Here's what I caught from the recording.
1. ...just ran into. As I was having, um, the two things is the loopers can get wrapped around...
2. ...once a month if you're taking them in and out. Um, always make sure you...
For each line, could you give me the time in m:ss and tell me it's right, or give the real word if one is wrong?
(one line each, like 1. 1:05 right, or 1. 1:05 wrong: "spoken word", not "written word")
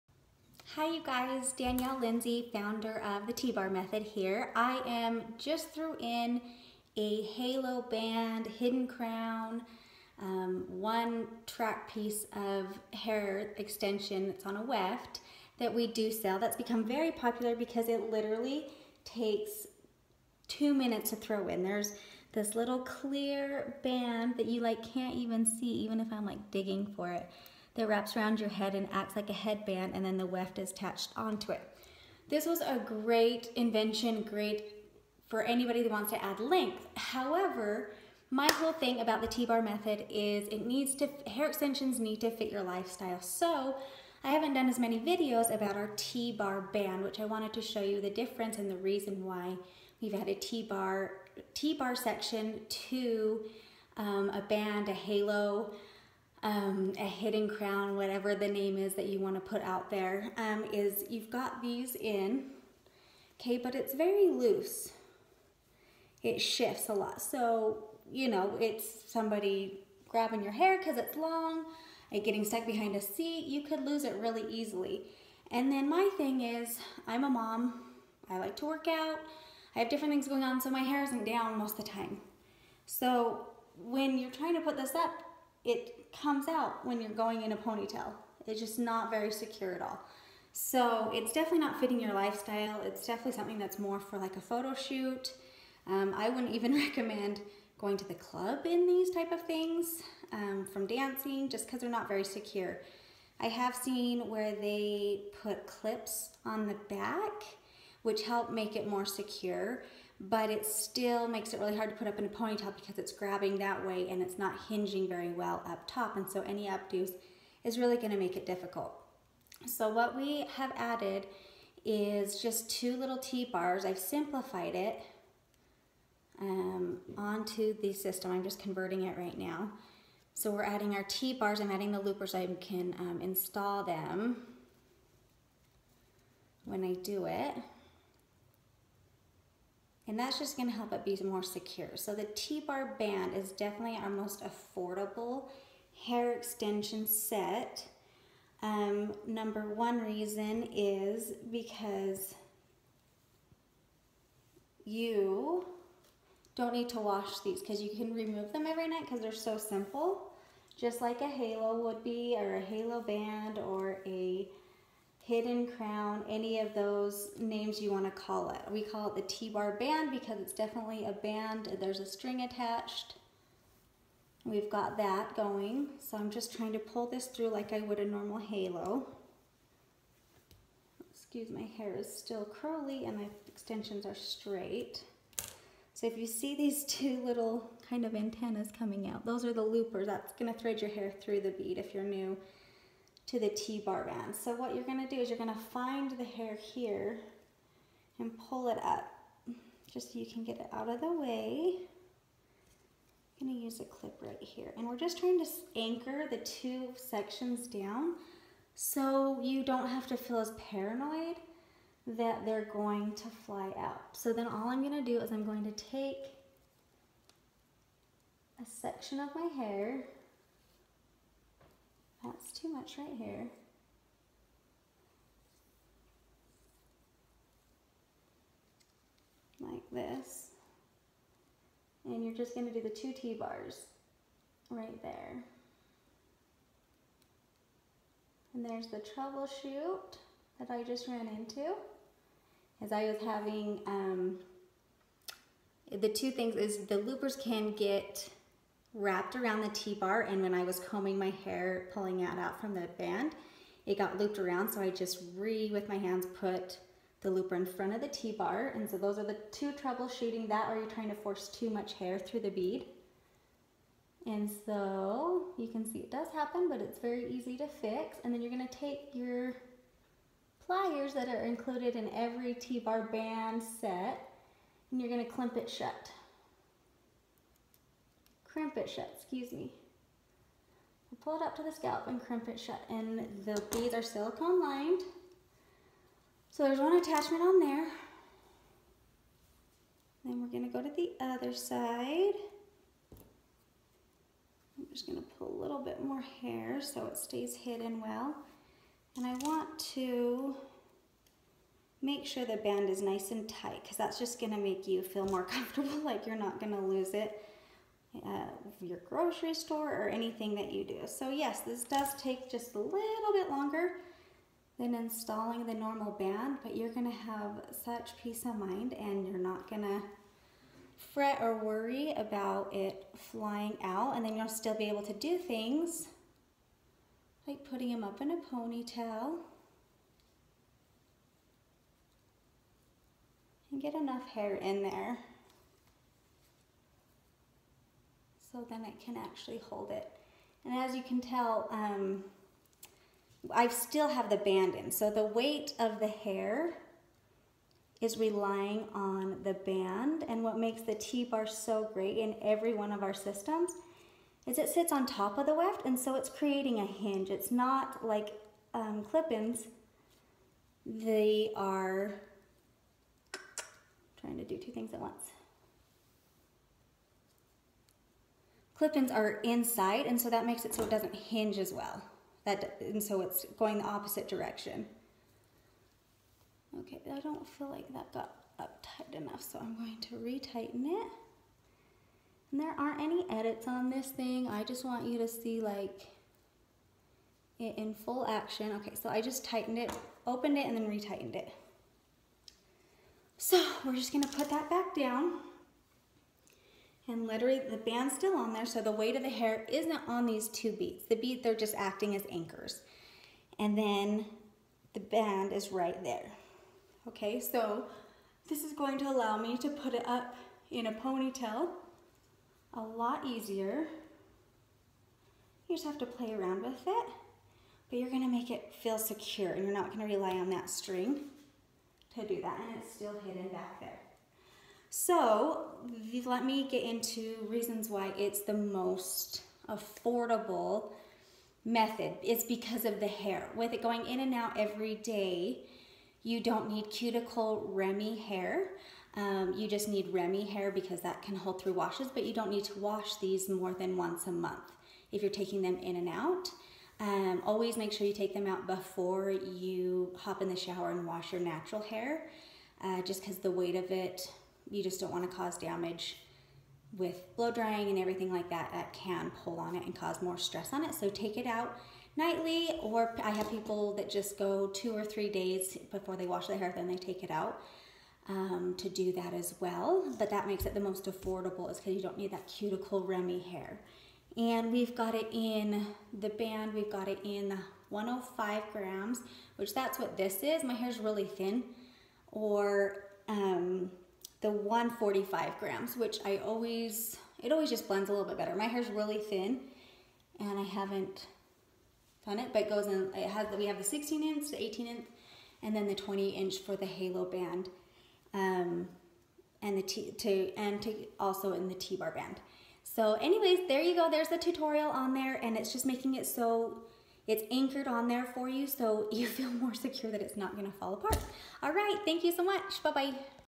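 1. 4:00 right
2. 7:23 right.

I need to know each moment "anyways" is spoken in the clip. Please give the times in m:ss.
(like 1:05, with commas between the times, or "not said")
8:23.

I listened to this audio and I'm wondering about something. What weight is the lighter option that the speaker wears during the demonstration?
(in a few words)
105 grams.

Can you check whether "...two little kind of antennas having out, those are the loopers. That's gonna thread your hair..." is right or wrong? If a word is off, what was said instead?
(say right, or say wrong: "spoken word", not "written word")
wrong: "coming", not "having".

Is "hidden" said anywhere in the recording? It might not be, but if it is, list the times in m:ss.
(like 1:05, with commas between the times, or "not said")
0:08, 0:57, 2:45, 4:57, 7:03.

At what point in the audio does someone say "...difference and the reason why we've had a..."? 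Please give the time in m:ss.
0:48.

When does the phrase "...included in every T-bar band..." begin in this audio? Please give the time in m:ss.
4:31.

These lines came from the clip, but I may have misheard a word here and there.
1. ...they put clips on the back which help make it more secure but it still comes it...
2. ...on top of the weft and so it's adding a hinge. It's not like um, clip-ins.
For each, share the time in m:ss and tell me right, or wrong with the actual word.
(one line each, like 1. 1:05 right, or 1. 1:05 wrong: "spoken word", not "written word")
1. 1:44 wrong: "makes", not "comes"
2. 5:54 wrong: "creating", not "adding".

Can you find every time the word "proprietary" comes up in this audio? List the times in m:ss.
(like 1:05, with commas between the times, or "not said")
not said.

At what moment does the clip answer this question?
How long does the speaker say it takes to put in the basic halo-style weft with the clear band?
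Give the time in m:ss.
0:20.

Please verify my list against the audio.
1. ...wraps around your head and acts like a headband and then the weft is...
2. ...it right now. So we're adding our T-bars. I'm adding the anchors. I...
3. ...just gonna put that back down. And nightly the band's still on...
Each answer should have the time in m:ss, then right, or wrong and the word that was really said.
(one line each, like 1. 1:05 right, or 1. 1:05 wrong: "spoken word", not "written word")
1. 0:27 right
2. 2:09 wrong: "loopers", not "anchors"
3. 6:33 wrong: "literally", not "nightly".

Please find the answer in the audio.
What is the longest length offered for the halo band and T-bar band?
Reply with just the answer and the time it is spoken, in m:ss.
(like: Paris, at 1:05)
20 inch, at 8:15.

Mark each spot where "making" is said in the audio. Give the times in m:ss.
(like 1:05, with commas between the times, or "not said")
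8:25.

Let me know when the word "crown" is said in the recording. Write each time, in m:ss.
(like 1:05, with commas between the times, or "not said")
0:08, 0:57, 2:45.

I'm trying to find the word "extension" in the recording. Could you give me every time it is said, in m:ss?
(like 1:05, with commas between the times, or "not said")
0:13, 0:41, 2:26, 3:03.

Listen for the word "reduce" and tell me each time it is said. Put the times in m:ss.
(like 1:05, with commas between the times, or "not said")
not said.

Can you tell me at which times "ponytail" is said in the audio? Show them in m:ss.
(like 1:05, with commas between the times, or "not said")
1:27, 1:52, 5:28, 6:50.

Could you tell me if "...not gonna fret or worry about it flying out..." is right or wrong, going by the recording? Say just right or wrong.
right.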